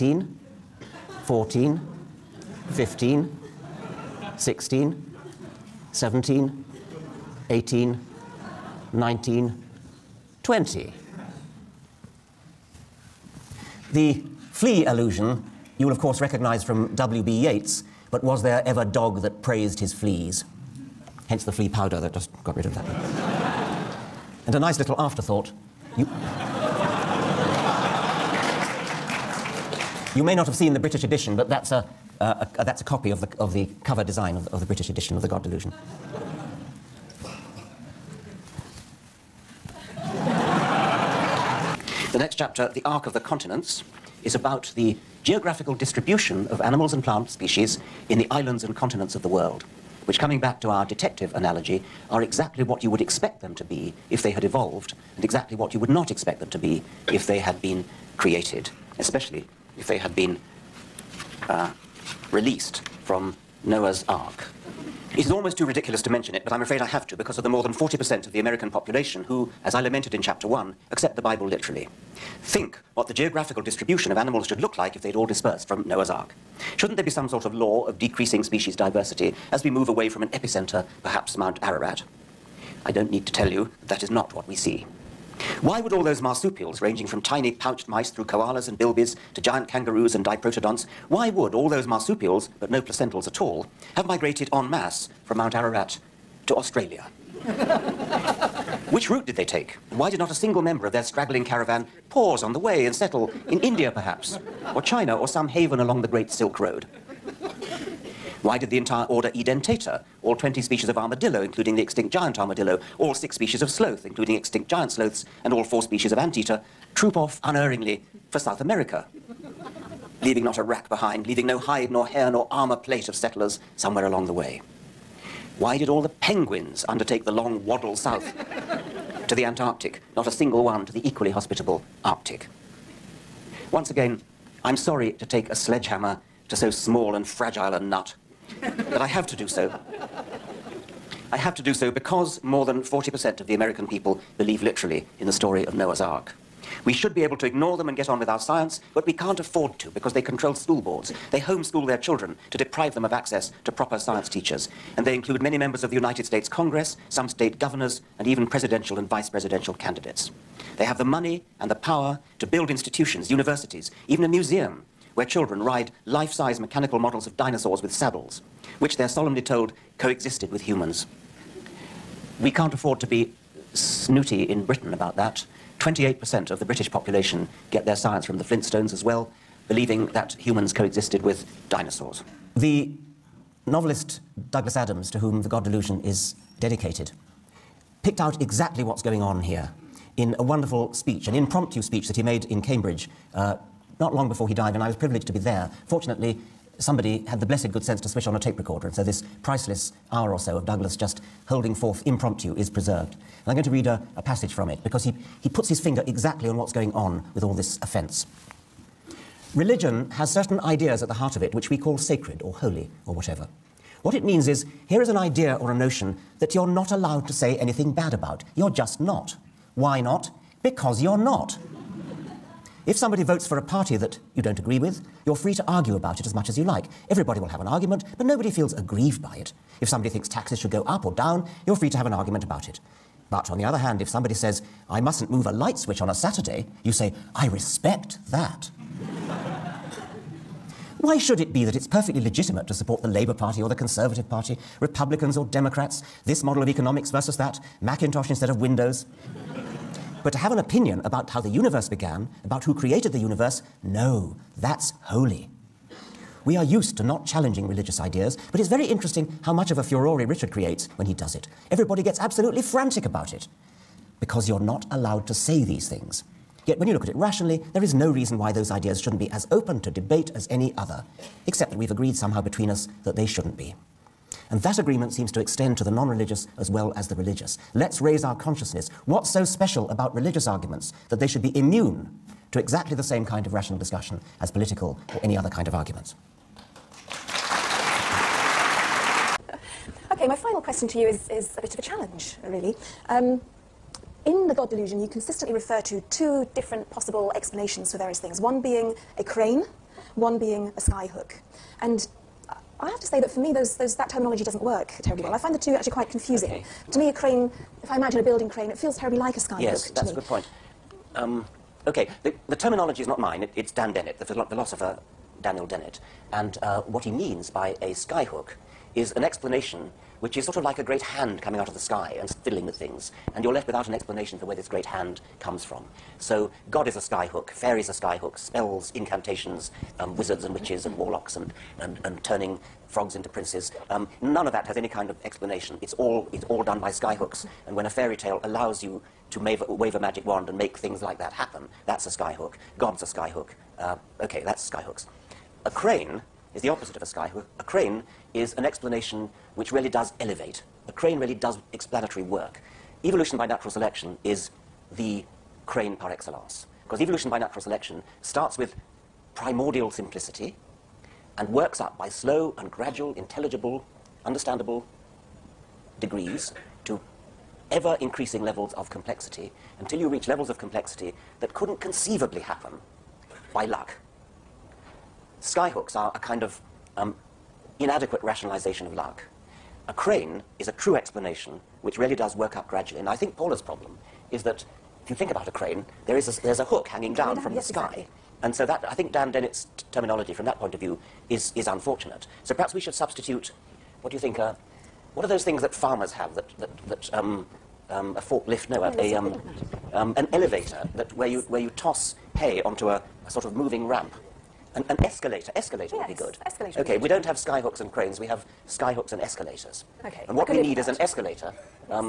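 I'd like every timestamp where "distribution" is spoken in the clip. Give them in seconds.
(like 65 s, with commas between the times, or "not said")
45 s, 73 s.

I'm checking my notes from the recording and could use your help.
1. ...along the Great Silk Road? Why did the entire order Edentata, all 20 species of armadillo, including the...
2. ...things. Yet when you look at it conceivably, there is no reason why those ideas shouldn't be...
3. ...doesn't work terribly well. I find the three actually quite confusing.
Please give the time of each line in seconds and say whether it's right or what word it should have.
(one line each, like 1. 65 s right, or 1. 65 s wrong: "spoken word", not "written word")
1. 105 s right
2. 265 s wrong: "rationally", not "conceivably"
3. 304 s wrong: "two", not "three".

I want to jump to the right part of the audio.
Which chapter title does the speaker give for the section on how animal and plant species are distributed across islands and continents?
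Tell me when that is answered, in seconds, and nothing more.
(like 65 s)
42 s.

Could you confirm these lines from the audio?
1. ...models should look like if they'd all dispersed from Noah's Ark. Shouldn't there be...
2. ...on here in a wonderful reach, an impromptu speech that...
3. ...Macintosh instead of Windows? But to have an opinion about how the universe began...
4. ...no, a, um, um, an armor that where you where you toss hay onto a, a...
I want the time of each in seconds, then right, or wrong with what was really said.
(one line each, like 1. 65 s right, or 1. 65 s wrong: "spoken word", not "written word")
1. 74 s wrong: "animals", not "models"
2. 189 s wrong: "speech", not "reach"
3. 247 s right
4. 398 s wrong: "elevator", not "armor".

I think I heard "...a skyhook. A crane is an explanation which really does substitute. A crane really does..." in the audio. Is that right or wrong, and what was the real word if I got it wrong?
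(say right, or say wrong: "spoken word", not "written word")
wrong: "elevate", not "substitute".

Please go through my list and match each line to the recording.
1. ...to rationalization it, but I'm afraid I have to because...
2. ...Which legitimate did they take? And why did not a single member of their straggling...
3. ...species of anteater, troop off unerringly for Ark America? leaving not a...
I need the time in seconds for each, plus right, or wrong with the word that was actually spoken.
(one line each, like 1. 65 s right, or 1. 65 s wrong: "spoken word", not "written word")
1. 66 s wrong: "mention", not "rationalization"
2. 98 s wrong: "route", not "legitimate"
3. 115 s wrong: "South", not "Ark".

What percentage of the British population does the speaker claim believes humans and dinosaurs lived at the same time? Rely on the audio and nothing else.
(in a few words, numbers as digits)
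28%.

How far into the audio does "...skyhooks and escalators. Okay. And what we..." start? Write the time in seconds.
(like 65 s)
408 s.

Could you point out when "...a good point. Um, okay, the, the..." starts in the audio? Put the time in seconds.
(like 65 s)
310 s.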